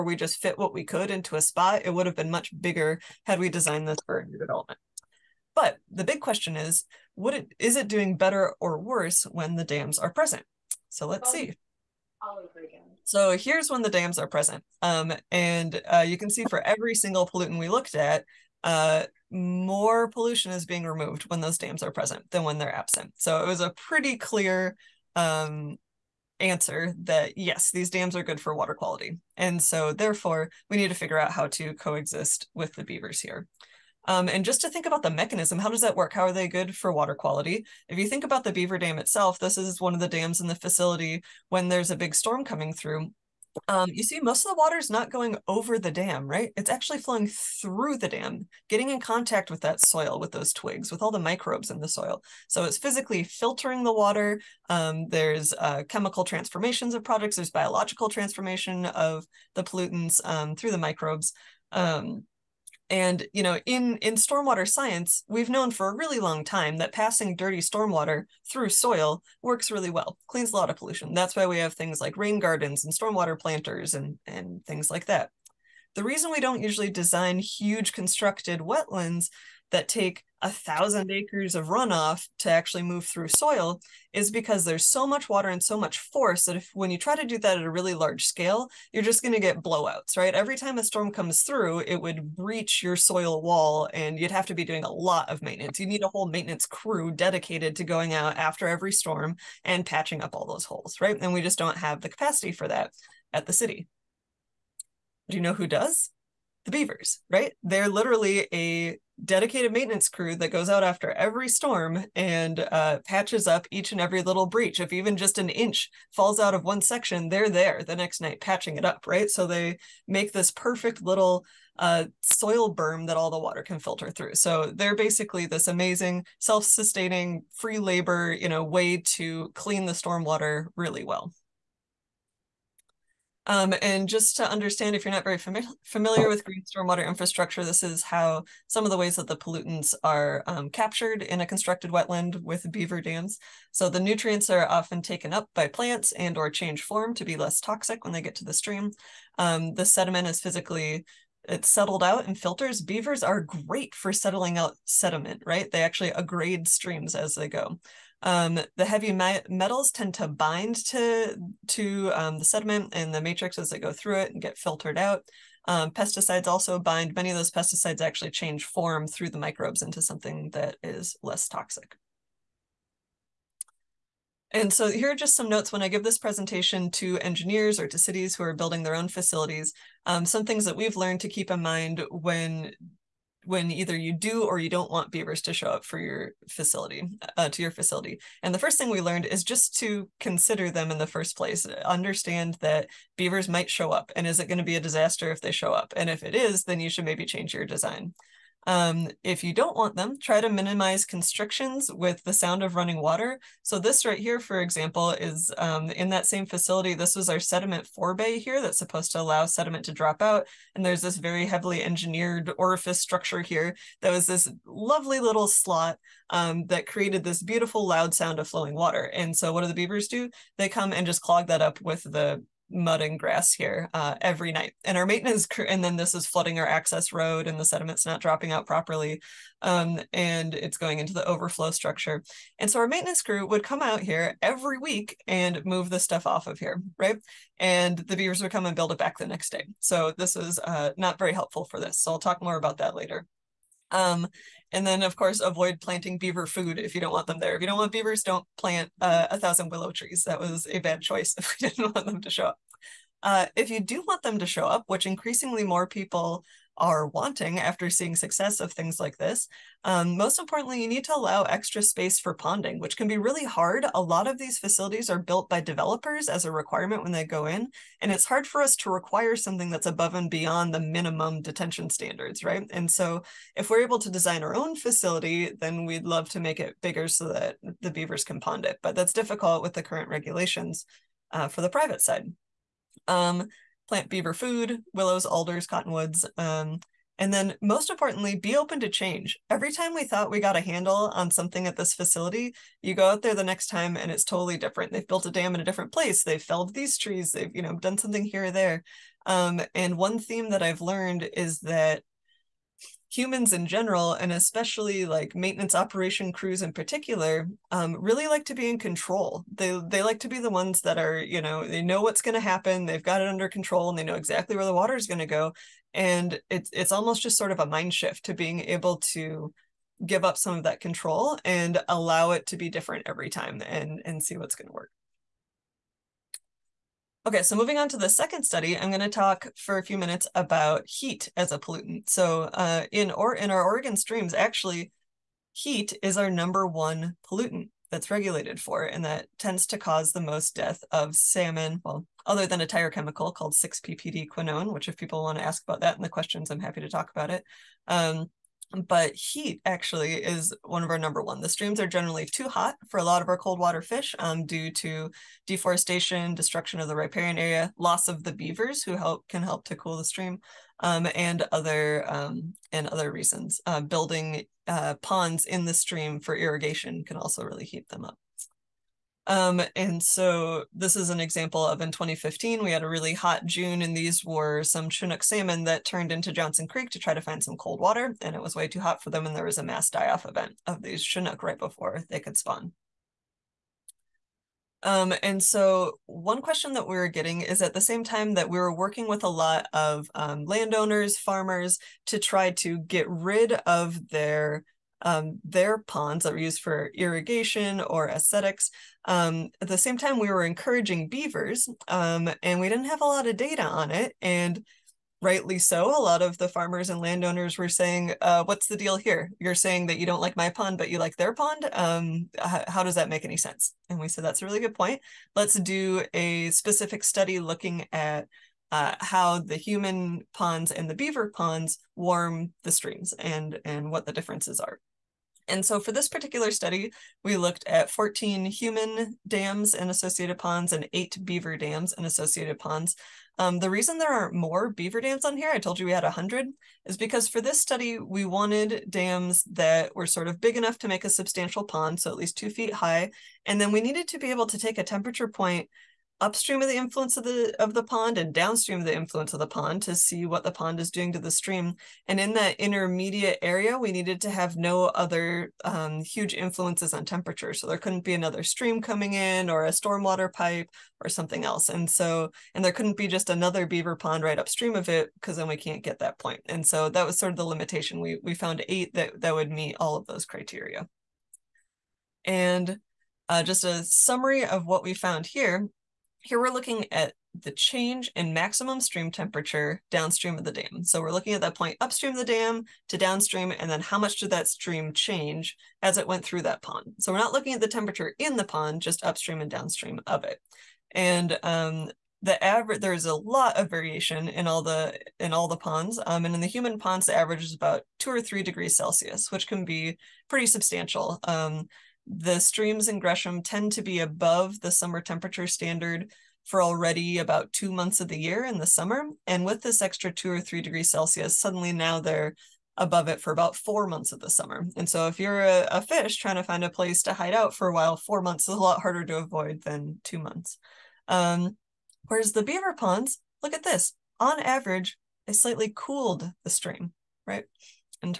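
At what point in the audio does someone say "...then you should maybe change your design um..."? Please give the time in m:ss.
3:16.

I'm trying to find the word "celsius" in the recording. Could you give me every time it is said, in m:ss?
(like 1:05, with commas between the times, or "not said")
8:18, 8:30.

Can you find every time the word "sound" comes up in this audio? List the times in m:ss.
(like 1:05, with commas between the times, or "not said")
3:22, 3:38.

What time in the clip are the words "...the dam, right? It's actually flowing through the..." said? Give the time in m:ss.
0:45.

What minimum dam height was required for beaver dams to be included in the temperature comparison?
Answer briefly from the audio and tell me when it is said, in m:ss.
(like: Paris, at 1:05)
2 feet, at 7:22.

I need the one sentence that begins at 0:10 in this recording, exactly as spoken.
So let's see all over again.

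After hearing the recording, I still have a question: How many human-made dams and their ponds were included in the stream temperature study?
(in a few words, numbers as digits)
14.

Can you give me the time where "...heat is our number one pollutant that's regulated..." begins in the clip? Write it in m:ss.
5:35.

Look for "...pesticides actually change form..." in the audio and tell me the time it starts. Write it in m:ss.
2:47.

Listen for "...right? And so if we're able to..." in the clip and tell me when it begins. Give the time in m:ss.
4:32.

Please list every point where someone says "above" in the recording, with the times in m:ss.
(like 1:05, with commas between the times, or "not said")
4:29, 8:23, 8:32.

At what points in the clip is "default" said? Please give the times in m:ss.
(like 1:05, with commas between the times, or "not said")
not said.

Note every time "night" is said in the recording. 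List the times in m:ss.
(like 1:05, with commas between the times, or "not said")
1:58, 3:44.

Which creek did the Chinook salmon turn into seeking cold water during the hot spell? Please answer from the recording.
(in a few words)
Johnson Creek.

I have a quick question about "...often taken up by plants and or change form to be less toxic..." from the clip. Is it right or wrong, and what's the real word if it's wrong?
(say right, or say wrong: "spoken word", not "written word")
right.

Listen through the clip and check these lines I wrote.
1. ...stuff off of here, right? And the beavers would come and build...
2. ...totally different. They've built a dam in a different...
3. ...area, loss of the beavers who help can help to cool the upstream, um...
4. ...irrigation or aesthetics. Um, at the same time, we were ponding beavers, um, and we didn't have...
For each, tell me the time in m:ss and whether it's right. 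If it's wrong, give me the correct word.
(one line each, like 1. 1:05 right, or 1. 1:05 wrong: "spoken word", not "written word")
1. 3:55 right
2. 4:54 right
3. 5:57 wrong: "stream", not "upstream"
4. 6:36 wrong: "encouraging", not "ponding".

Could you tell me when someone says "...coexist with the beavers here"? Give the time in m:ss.
0:31.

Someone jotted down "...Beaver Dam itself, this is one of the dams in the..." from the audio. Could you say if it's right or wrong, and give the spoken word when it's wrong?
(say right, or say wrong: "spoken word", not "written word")
right.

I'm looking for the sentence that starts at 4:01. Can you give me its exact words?
So I'll talk more about that later.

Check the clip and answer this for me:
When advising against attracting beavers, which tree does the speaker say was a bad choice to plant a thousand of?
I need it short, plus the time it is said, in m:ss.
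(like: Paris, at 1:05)
willow, at 4:09.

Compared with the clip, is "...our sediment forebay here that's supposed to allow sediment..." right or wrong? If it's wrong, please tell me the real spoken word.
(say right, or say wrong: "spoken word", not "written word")
right.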